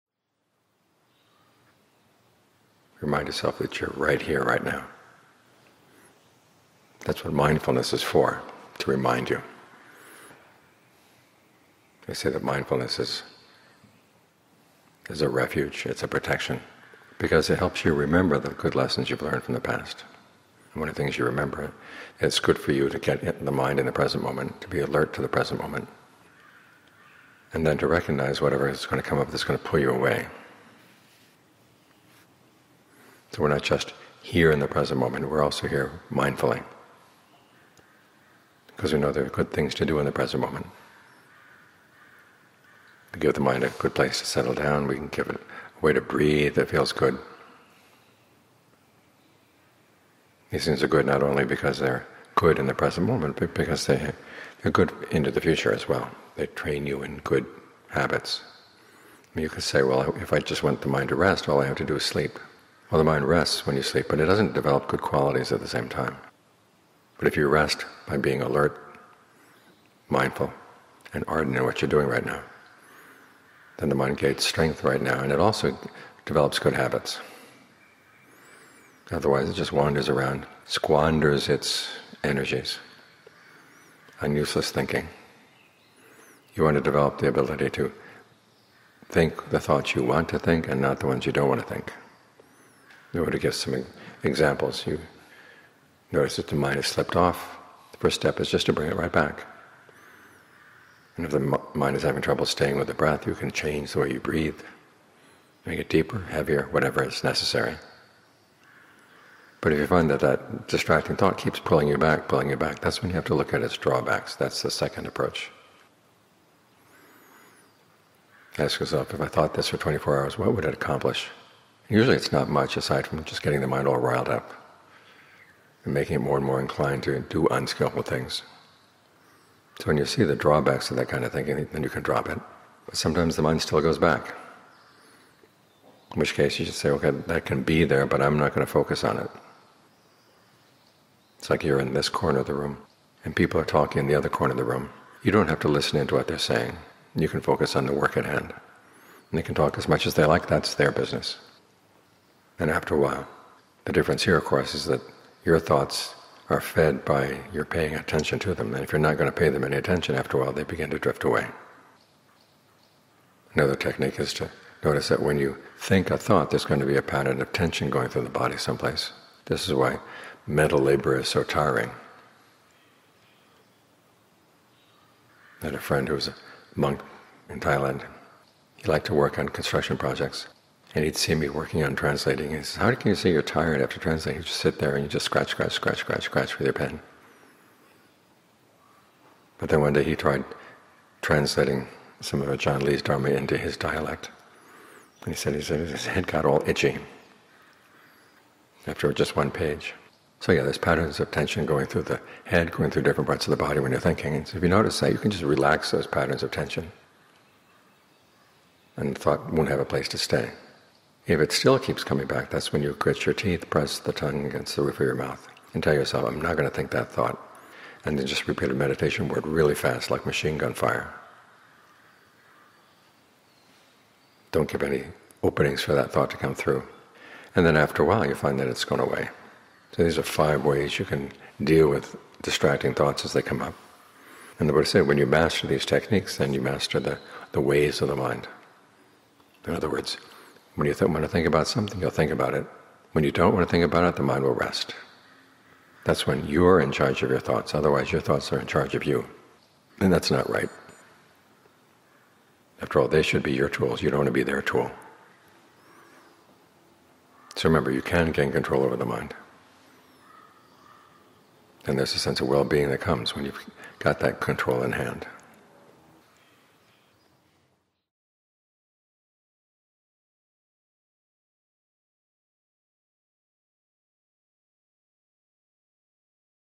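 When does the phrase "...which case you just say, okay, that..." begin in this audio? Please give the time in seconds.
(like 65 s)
136 s.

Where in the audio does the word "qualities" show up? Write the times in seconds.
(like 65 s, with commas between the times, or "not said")
64 s.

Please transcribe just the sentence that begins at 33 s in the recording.
So we're not just here in the present moment, we're also here mindfully.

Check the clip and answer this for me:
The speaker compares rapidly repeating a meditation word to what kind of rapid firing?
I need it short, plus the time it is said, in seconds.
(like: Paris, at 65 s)
machine gun fire, at 220 s.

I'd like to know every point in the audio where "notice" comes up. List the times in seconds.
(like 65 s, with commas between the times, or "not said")
96 s, 164 s, 204 s.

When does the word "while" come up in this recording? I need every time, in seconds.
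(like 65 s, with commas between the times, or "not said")
152 s, 160 s, 228 s.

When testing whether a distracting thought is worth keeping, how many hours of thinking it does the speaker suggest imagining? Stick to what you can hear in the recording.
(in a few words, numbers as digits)
24.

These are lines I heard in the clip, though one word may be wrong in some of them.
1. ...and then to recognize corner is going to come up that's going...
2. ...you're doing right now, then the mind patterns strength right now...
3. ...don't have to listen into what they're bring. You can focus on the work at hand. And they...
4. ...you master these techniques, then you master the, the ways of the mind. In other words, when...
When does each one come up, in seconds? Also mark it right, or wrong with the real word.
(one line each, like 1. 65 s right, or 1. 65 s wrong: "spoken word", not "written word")
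1. 27 s wrong: "whatever", not "corner"
2. 71 s wrong: "gains", not "patterns"
3. 145 s wrong: "saying", not "bring"
4. 235 s right.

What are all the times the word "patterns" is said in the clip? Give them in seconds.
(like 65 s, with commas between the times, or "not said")
167 s, 200 s, 206 s.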